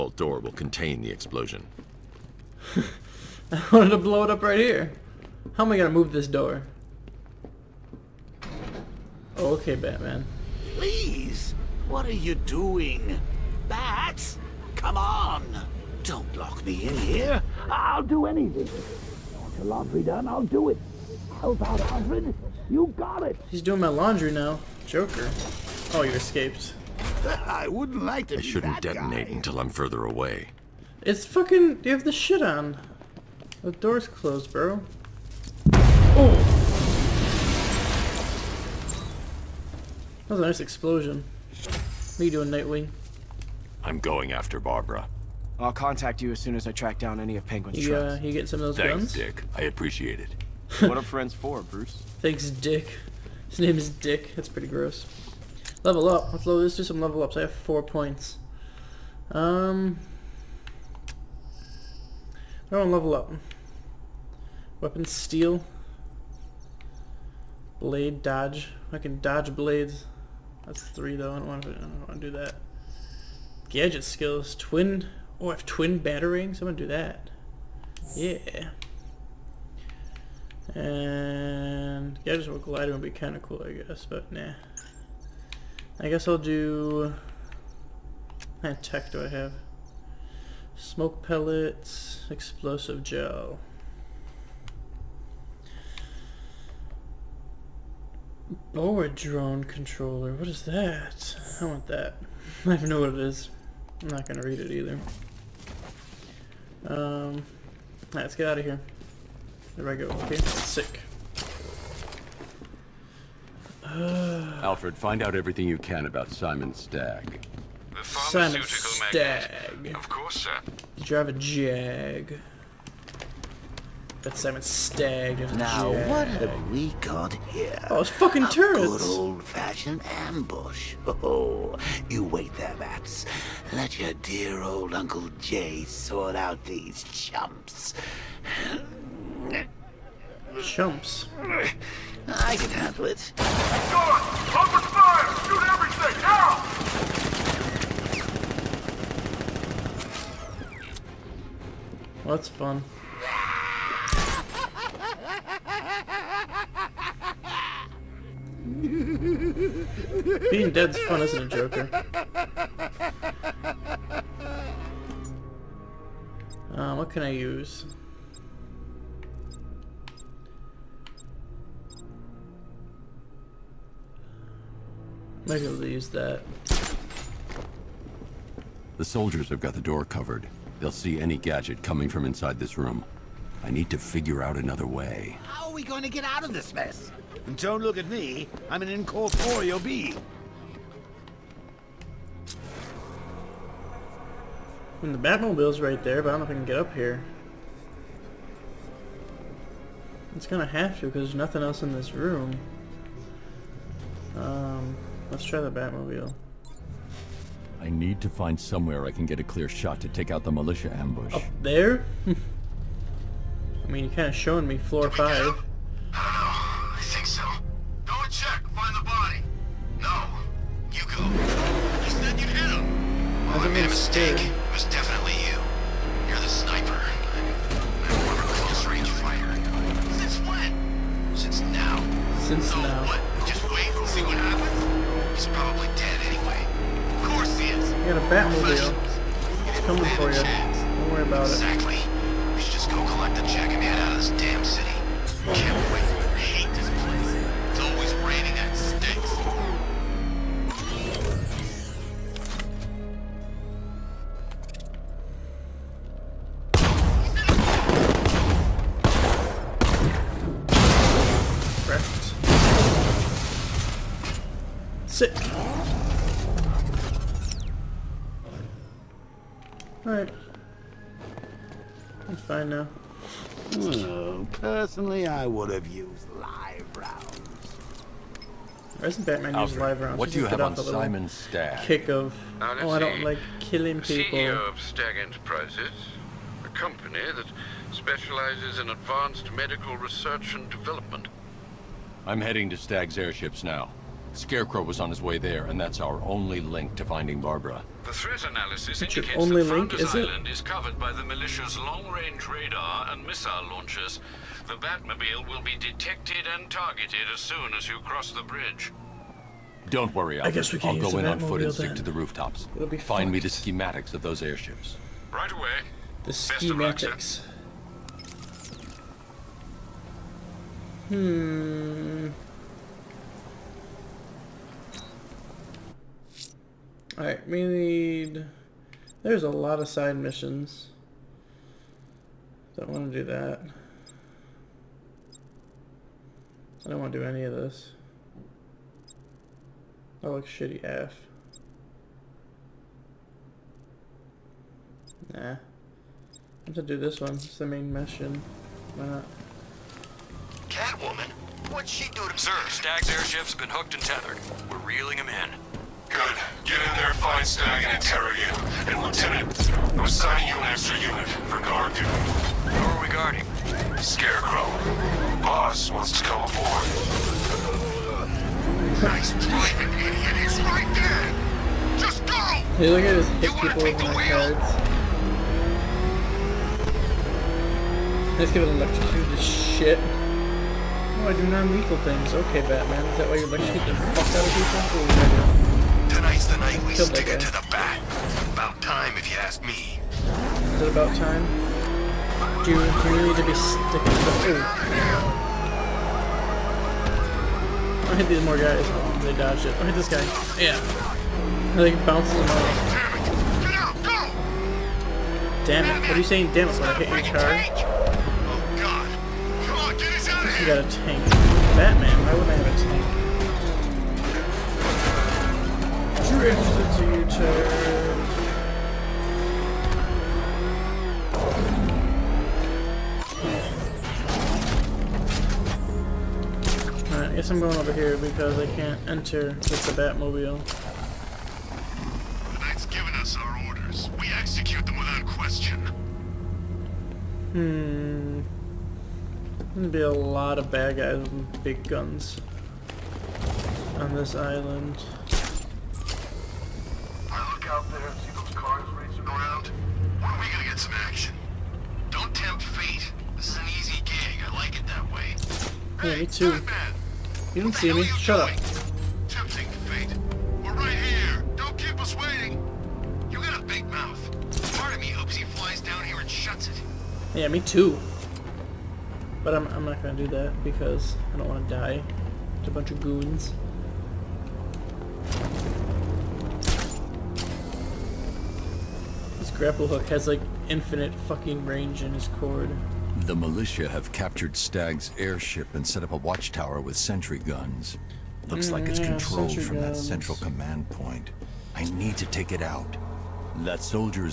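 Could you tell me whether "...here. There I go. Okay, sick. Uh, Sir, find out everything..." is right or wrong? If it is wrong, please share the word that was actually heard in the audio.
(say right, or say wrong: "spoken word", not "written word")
wrong: "Alfred", not "Sir".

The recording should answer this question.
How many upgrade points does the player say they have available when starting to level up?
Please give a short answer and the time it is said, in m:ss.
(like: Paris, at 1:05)
4, at 0:57.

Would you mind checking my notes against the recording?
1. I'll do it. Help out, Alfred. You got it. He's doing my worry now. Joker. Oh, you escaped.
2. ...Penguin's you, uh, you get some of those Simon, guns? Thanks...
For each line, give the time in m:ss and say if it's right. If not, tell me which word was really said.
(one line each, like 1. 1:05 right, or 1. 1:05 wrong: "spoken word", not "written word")
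1. 0:20 wrong: "laundry", not "worry"
2. 0:47 wrong: "Thanks", not "Simon".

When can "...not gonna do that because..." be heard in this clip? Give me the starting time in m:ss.
7:49.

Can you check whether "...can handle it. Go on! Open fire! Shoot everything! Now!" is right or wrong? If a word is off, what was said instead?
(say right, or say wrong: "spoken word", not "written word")
right.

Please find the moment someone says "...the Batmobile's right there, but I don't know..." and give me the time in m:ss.
3:15.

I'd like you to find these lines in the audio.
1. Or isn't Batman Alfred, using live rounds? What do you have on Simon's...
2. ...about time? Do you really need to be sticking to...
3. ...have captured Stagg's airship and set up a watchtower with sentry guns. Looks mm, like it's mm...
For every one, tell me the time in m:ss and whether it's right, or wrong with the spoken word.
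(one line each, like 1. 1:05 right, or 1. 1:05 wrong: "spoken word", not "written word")
1. 4:39 right
2. 6:30 right
3. 8:03 right.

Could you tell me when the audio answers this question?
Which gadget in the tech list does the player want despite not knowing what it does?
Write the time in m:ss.
1:38.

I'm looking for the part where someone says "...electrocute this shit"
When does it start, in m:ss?
6:18.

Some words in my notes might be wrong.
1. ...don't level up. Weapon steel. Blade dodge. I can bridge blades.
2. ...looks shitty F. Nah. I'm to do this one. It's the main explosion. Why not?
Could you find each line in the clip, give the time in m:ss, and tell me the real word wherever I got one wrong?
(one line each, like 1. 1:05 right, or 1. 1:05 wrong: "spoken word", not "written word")
1. 1:02 wrong: "dodge", not "bridge"
2. 5:40 wrong: "mission", not "explosion".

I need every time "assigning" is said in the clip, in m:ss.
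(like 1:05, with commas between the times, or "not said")
6:00.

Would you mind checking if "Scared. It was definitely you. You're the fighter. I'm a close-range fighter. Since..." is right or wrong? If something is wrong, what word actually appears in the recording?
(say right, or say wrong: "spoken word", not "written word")
wrong: "sniper", not "fighter".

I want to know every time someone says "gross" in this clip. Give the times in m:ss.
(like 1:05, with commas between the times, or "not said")
0:54.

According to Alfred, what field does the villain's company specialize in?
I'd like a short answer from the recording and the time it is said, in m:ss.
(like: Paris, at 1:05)
Advanced medical research, at 4:48.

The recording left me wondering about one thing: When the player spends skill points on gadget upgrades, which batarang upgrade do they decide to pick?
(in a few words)
Twin batarangs.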